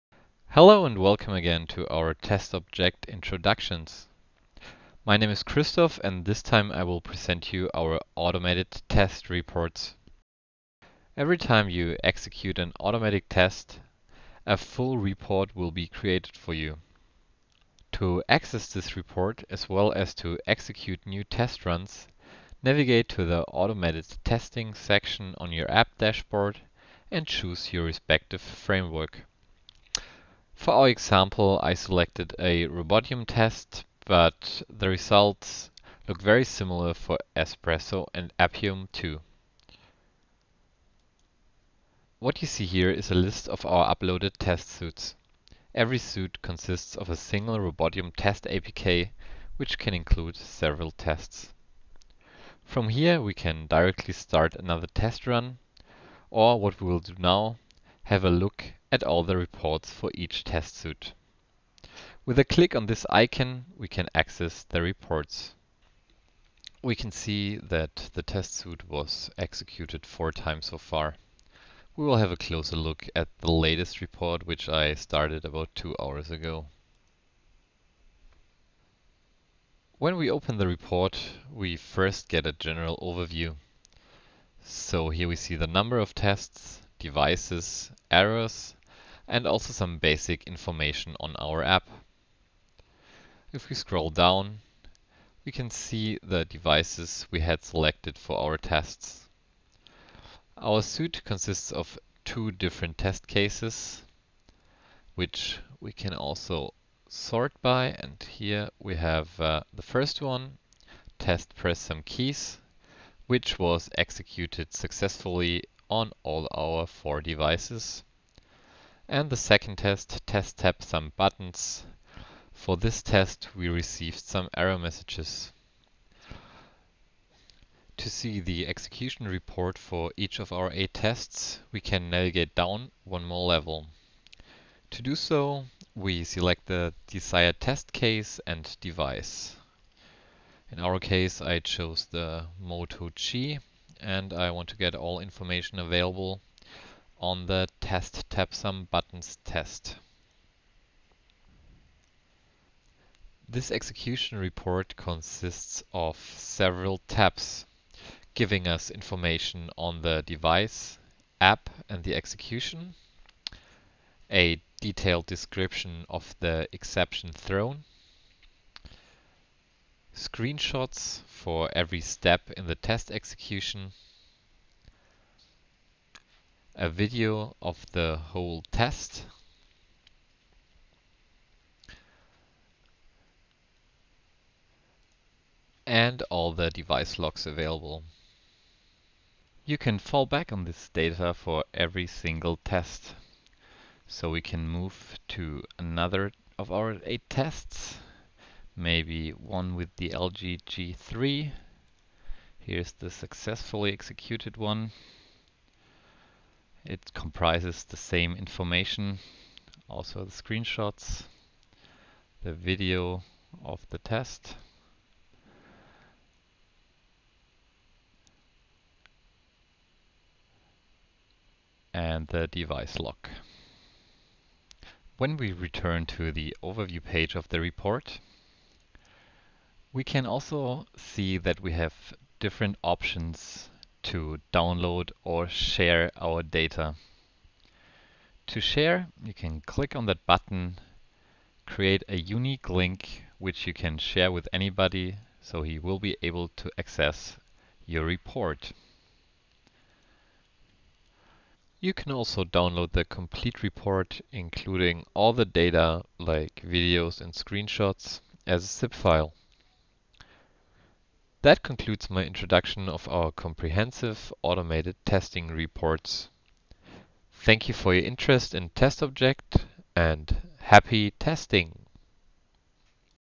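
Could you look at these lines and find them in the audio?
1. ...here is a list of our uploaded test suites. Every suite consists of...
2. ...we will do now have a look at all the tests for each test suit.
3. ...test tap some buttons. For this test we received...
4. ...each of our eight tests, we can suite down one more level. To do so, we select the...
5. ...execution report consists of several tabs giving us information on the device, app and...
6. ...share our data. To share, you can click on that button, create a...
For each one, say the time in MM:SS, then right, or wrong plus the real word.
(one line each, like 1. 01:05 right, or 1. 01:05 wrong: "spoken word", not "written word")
1. 00:42 right
2. 00:56 wrong: "reports", not "tests"
3. 02:00 right
4. 02:10 wrong: "navigate", not "suite"
5. 02:33 right
6. 03:55 right.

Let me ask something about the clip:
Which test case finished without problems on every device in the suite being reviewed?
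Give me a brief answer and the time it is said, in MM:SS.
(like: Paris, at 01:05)
test press some keys, at 01:51.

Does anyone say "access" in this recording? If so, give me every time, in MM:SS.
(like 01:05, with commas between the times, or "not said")
00:18, 01:04, 04:06.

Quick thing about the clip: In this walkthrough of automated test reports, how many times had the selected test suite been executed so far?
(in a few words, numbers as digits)
4.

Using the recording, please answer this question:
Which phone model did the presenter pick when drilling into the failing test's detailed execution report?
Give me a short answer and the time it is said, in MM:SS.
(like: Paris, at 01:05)
Moto G, at 02:22.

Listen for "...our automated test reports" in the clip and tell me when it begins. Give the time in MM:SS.
00:07.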